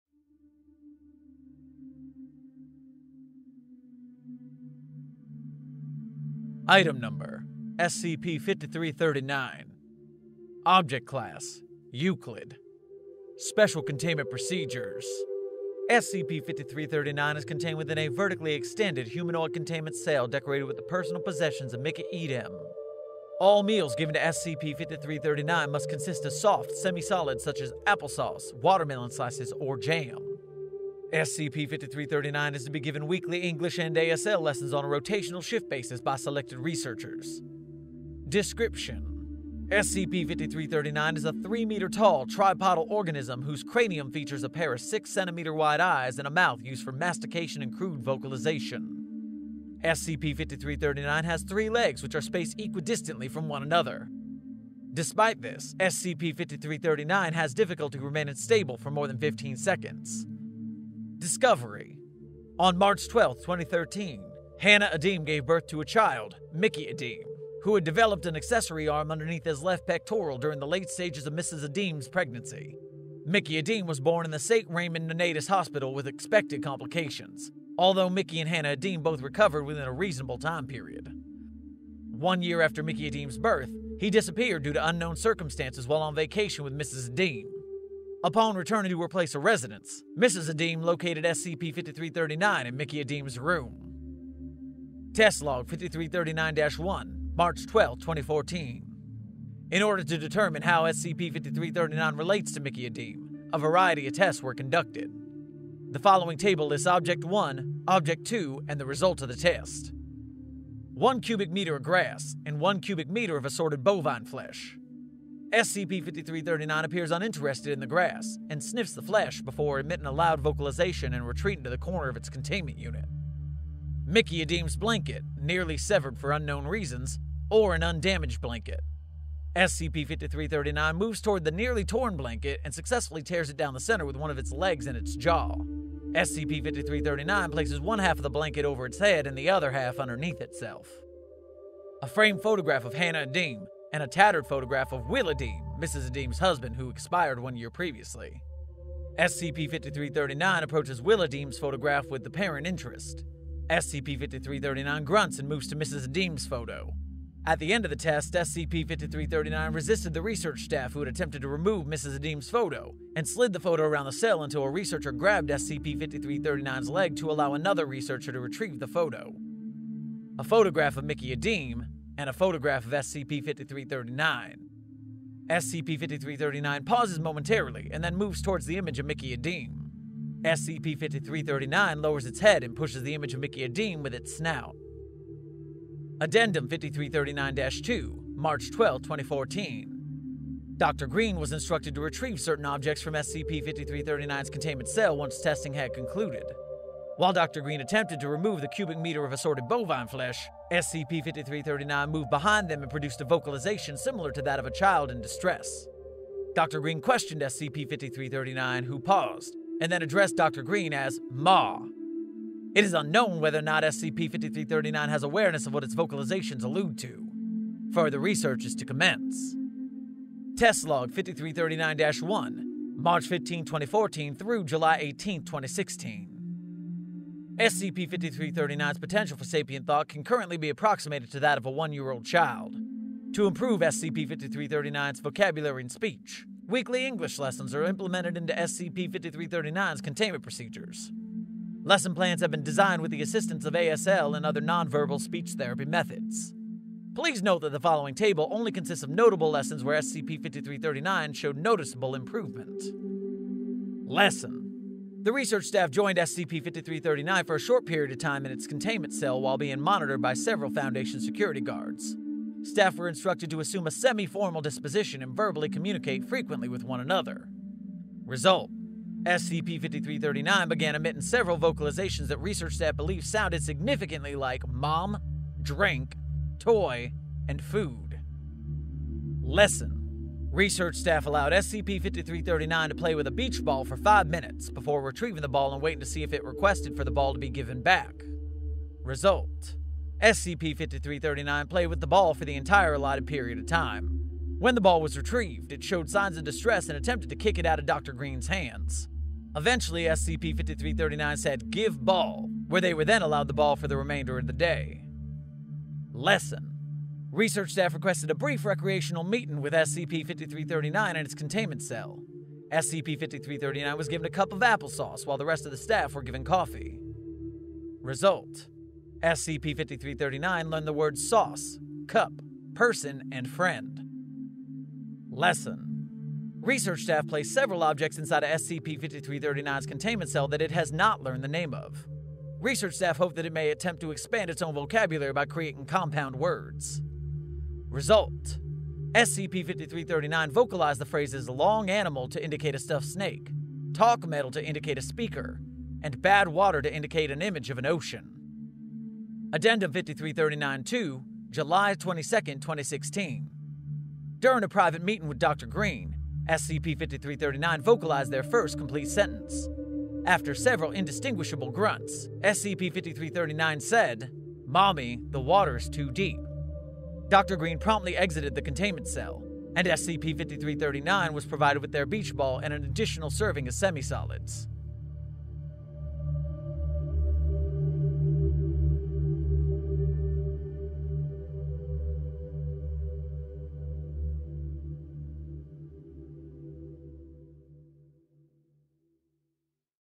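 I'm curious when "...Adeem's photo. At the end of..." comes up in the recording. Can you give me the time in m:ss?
2:36.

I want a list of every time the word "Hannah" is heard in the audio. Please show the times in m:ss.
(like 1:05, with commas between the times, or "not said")
1:04, 1:18, 2:22.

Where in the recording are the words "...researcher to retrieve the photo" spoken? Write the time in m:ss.
2:47.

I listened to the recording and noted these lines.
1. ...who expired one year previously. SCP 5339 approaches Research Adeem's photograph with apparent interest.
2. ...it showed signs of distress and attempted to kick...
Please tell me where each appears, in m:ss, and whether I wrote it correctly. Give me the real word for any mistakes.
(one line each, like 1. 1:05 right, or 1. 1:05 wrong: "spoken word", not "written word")
1. 2:26 wrong: "Will", not "Research"
2. 4:55 right.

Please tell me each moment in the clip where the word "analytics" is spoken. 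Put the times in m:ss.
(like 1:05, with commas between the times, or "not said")
not said.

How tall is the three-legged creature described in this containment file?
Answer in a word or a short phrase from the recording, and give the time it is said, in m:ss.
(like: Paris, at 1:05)
3 meters, at 0:41.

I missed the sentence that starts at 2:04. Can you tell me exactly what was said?
Mickey Adem's blanket, nearly severed for unknown reasons, or an undamaged blanket.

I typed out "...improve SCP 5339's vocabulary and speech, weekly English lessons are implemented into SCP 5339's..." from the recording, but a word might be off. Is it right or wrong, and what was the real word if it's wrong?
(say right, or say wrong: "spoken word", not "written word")
right.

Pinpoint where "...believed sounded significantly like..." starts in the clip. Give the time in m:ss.
4:32.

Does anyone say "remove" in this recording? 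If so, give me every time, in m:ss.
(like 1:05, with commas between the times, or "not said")
2:41, 3:18.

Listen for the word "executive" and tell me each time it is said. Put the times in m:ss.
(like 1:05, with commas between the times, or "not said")
not said.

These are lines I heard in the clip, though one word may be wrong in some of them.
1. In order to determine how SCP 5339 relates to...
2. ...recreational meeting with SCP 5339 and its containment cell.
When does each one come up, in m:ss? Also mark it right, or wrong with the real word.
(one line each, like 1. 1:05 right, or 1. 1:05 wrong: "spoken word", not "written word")
1. 1:39 right
2. 5:08 right.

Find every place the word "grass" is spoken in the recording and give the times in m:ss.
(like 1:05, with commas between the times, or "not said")
1:51, 1:57.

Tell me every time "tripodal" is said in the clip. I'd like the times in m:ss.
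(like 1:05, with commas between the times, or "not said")
0:42.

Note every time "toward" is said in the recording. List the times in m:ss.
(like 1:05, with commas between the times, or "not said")
2:11, 2:58.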